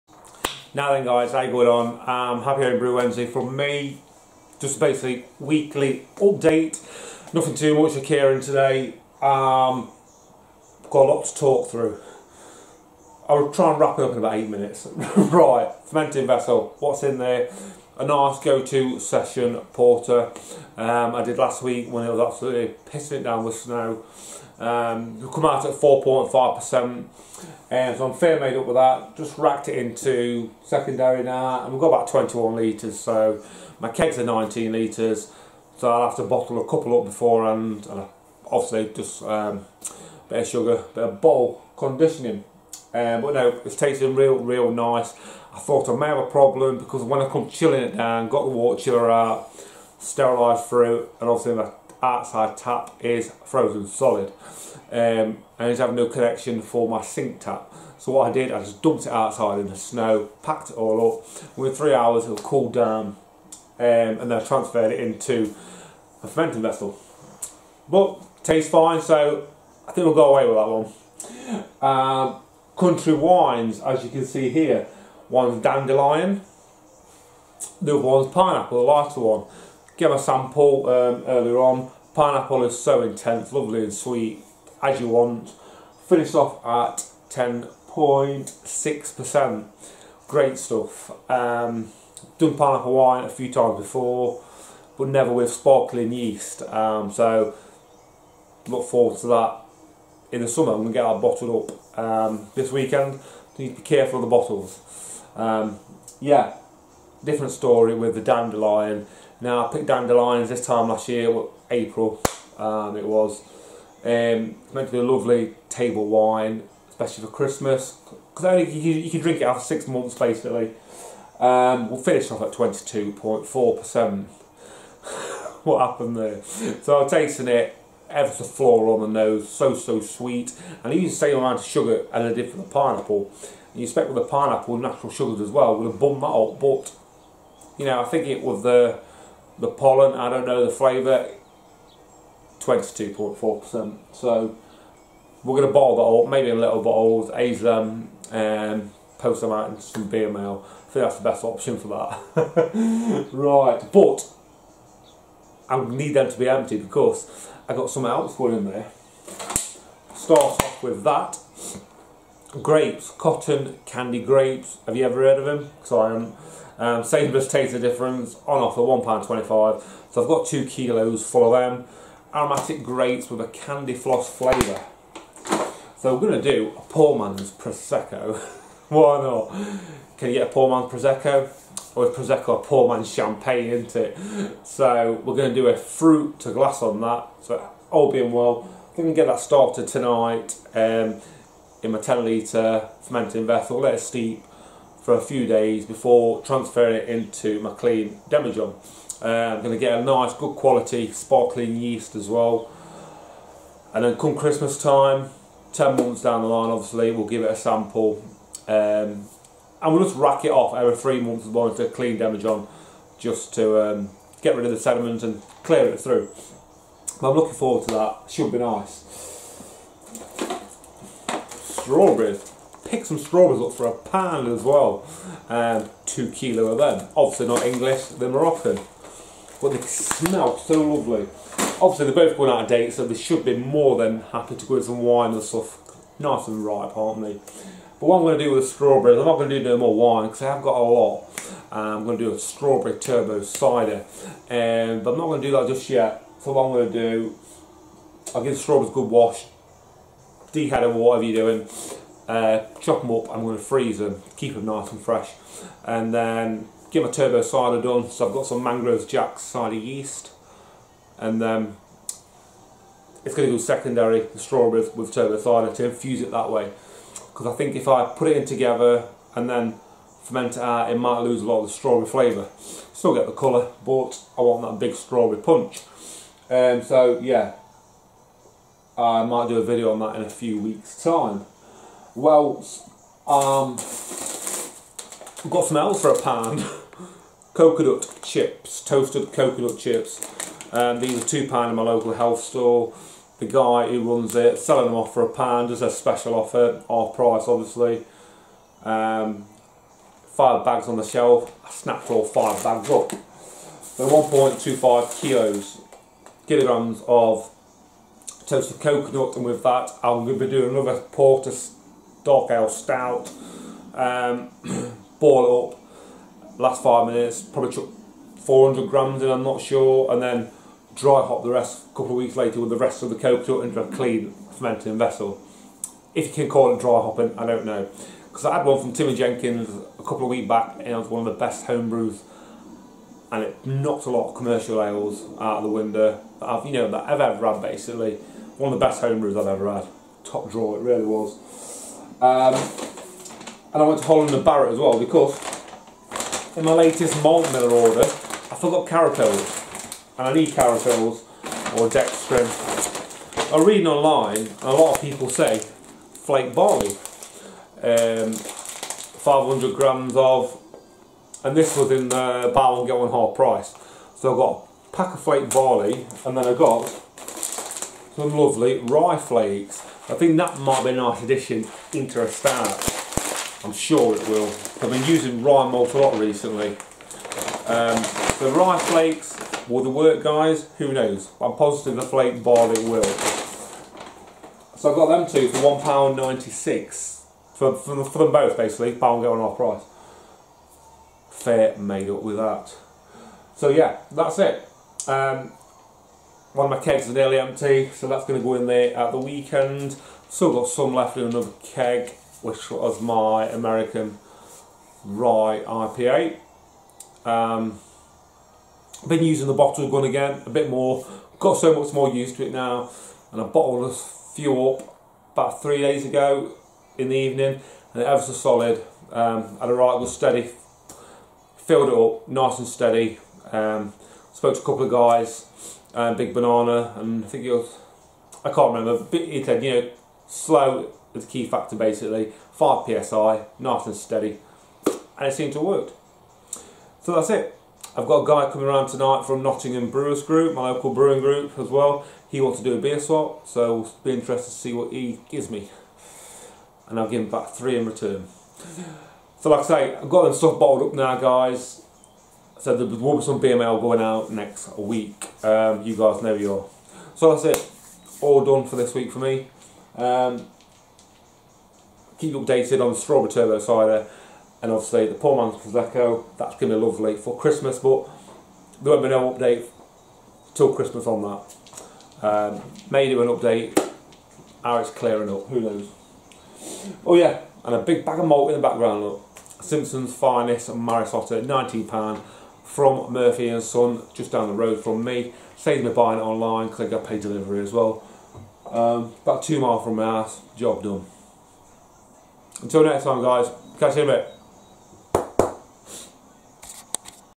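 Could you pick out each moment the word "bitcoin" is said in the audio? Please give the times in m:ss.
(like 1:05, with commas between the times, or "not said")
not said.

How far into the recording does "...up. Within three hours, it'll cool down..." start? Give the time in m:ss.
1:01.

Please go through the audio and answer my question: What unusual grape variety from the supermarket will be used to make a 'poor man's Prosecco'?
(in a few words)
cotton candy grapes.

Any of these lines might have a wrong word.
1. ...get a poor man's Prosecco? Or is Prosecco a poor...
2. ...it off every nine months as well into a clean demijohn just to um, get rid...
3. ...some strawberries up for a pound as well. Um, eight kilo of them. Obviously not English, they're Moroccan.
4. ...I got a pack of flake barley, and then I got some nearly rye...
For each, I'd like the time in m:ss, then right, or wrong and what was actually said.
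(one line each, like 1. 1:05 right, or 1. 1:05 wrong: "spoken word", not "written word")
1. 3:00 right
2. 3:30 wrong: "three", not "nine"
3. 3:43 wrong: "two", not "eight"
4. 6:04 wrong: "lovely", not "nearly".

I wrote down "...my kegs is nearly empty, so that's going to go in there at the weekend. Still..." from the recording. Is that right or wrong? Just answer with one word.
right.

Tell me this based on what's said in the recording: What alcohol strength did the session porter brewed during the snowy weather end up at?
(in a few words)
4.5%.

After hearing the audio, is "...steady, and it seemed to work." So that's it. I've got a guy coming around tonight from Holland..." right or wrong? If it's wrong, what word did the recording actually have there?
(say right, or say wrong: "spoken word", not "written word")
wrong: "Nottingham", not "Holland".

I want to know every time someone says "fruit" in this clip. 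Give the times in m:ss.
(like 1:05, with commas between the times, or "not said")
0:50, 3:05.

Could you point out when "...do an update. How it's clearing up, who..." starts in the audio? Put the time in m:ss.
7:53.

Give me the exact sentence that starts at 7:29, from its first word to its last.
So like I say, I've got them stuff bottled up now guys.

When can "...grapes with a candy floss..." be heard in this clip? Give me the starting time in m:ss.
2:52.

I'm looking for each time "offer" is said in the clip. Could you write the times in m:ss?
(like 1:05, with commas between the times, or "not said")
2:48, 4:56.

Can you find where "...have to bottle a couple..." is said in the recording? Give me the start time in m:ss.
0:36.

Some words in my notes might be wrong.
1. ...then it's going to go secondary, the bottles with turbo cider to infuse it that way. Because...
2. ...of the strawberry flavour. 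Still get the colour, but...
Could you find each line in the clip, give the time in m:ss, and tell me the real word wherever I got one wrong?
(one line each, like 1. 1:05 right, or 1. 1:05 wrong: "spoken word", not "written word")
1. 4:21 wrong: "strawberries", not "bottles"
2. 4:31 right.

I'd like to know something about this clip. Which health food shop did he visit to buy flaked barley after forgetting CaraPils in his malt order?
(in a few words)
Holland and Barrett.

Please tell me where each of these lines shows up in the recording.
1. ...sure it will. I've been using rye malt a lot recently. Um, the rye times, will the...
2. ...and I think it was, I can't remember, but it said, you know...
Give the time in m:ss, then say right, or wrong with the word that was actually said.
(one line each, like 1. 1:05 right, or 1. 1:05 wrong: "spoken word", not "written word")
1. 6:13 wrong: "flakes", not "times"
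2. 7:06 right.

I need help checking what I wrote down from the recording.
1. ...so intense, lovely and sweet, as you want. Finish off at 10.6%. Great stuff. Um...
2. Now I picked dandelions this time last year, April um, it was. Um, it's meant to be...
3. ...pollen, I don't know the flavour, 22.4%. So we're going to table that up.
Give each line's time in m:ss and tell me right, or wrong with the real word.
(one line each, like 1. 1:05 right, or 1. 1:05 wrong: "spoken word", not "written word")
1. 1:22 right
2. 1:49 right
3. 2:19 wrong: "bottle", not "table".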